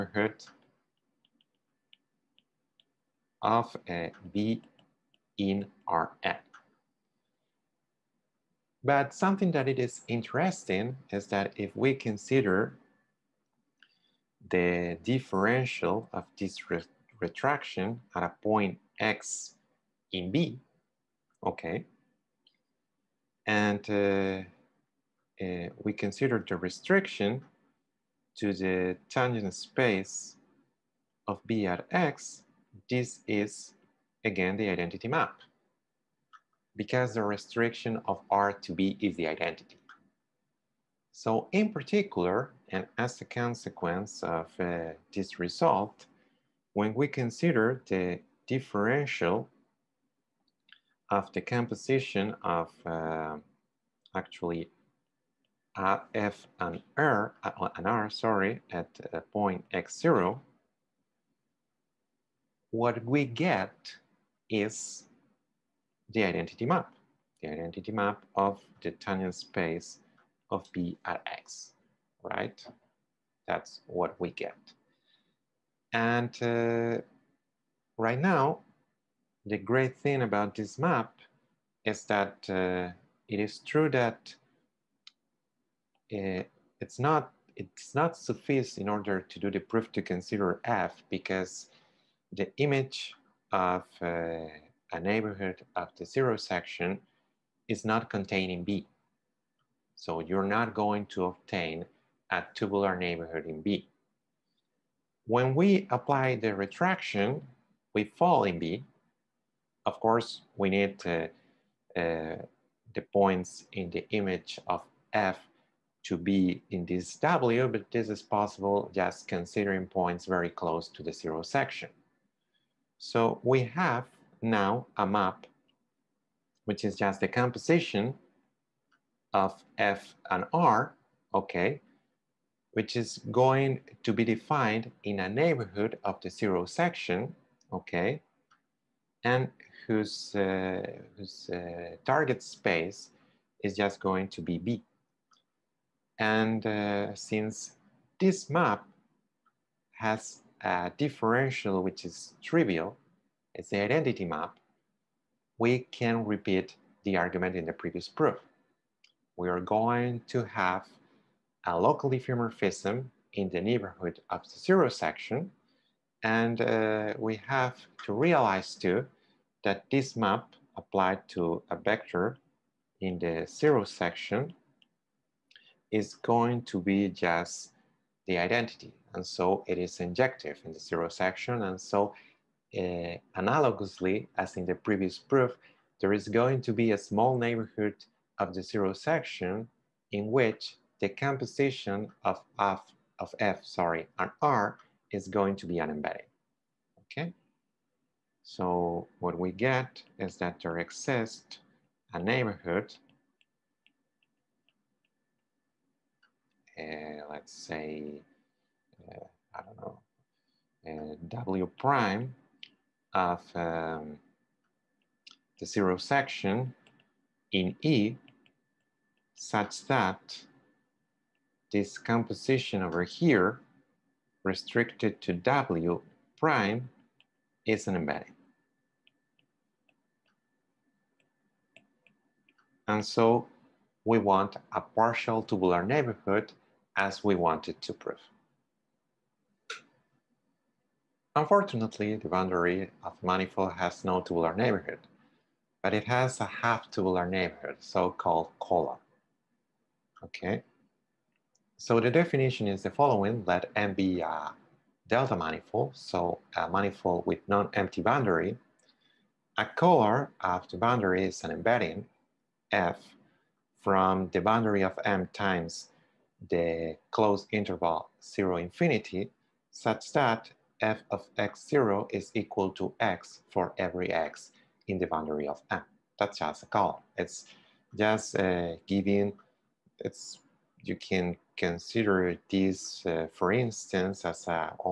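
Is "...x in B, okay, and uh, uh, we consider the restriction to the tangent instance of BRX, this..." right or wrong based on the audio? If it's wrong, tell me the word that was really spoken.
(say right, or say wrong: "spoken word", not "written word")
wrong: "space", not "instance".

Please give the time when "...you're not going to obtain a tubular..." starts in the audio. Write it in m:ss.
1:40.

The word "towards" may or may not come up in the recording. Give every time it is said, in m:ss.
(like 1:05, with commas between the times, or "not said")
not said.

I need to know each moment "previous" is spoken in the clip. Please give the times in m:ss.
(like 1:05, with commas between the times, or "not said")
2:37, 3:04.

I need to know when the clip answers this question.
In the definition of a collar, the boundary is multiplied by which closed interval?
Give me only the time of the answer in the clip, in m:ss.
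4:28.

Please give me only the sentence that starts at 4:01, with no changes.
Unfortunately, the boundary of the manifold has no tubular neighborhood, but it has a half tubular neighborhood, so-called collar.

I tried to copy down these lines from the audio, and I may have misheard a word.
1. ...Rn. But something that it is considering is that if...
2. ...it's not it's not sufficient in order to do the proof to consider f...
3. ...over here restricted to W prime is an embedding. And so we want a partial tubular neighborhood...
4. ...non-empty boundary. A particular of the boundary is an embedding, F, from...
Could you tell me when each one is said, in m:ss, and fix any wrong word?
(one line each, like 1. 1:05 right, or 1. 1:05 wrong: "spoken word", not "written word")
1. 0:05 wrong: "interesting", not "considering"
2. 1:26 right
3. 3:42 right
4. 4:17 wrong: "collar", not "particular".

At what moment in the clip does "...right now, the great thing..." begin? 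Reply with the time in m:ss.
1:17.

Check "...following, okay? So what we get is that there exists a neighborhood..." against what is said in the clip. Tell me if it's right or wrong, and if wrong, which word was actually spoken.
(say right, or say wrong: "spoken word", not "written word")
wrong: "embedding", not "following".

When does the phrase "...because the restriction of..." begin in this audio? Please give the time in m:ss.
0:36.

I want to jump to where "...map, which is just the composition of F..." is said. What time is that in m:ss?
2:05.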